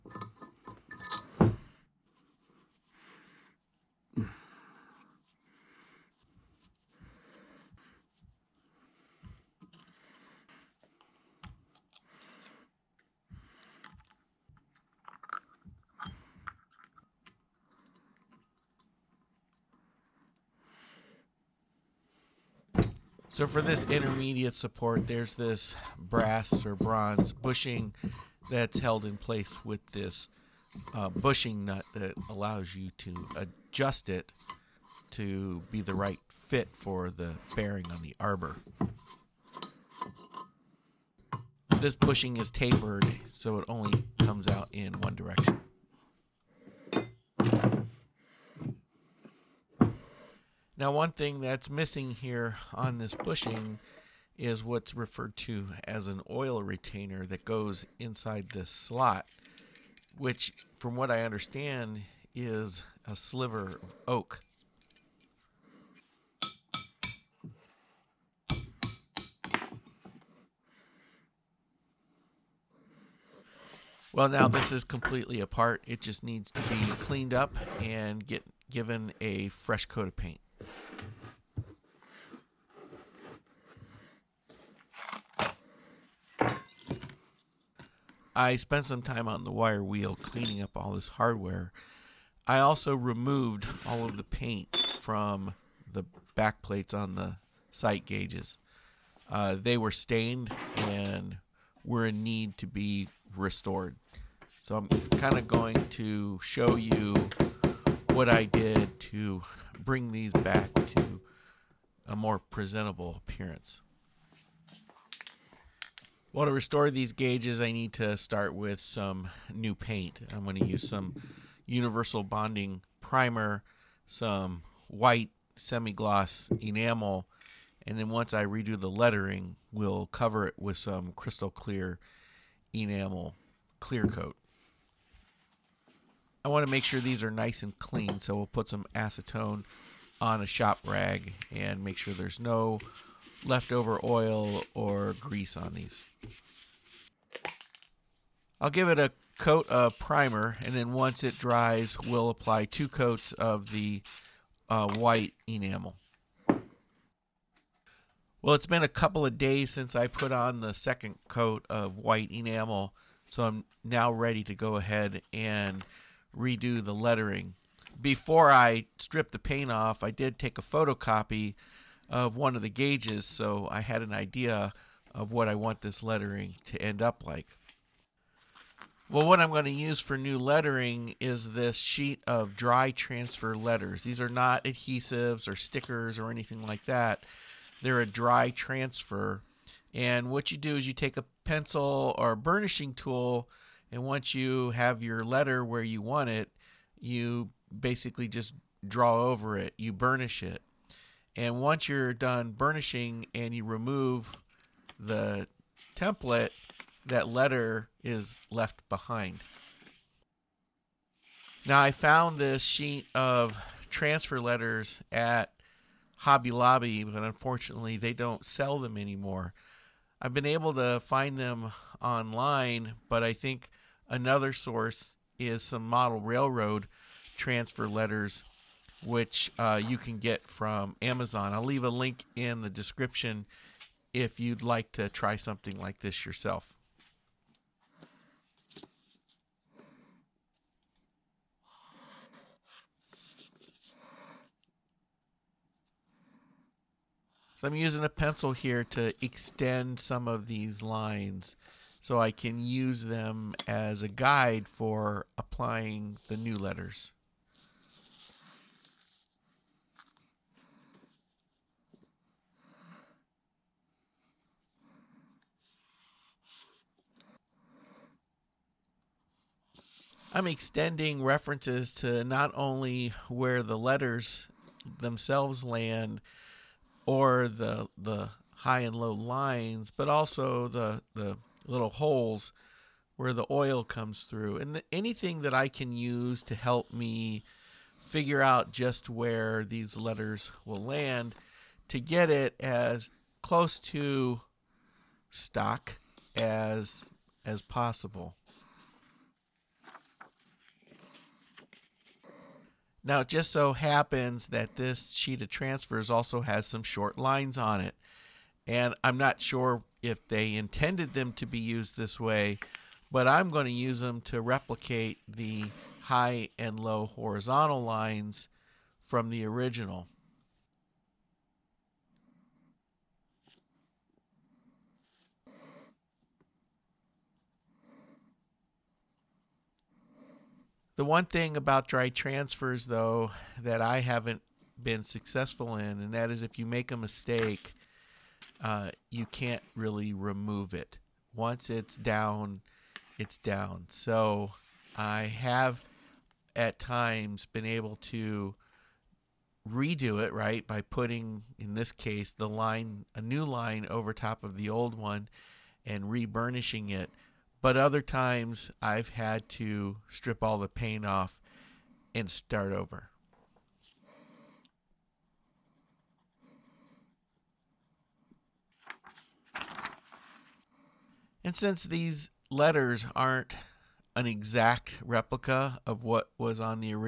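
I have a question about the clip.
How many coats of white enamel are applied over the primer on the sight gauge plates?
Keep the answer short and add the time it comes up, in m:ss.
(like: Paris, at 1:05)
2, at 2:32.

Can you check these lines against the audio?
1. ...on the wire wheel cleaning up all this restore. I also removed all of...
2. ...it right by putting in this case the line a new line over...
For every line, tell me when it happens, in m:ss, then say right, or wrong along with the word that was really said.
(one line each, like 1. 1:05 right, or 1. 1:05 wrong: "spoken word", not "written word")
1. 1:29 wrong: "hardware", not "restore"
2. 5:50 right.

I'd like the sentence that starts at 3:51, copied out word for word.
I'll leave a link in the description if you'd like to try something like this yourself.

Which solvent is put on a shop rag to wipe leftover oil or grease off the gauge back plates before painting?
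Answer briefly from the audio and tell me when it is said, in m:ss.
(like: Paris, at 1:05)
acetone, at 2:18.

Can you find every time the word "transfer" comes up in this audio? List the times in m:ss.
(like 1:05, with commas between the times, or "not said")
3:02, 3:08, 3:33, 3:47, 5:05, 5:32.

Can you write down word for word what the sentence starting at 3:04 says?
These are not adhesives or stickers or anything like that.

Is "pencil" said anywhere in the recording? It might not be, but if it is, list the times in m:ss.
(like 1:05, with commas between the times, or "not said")
3:11, 4:08.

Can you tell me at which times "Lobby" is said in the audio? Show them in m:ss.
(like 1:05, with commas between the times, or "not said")
3:36.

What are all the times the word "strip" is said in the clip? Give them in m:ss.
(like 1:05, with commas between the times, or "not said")
2:48, 6:00.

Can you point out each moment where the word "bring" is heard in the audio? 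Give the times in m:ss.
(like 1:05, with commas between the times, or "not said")
1:49.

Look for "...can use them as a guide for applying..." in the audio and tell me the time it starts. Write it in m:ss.
4:12.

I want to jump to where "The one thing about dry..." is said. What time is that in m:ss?
5:30.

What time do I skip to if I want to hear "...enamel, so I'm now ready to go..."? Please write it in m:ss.
2:42.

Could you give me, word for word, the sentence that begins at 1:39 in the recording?
Uh, they were stained and were in need to be restored.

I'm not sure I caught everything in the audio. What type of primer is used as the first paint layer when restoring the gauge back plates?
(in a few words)
universal bonding primer.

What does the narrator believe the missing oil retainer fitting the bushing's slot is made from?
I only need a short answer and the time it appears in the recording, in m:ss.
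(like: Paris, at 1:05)
a sliver of oak, at 1:03.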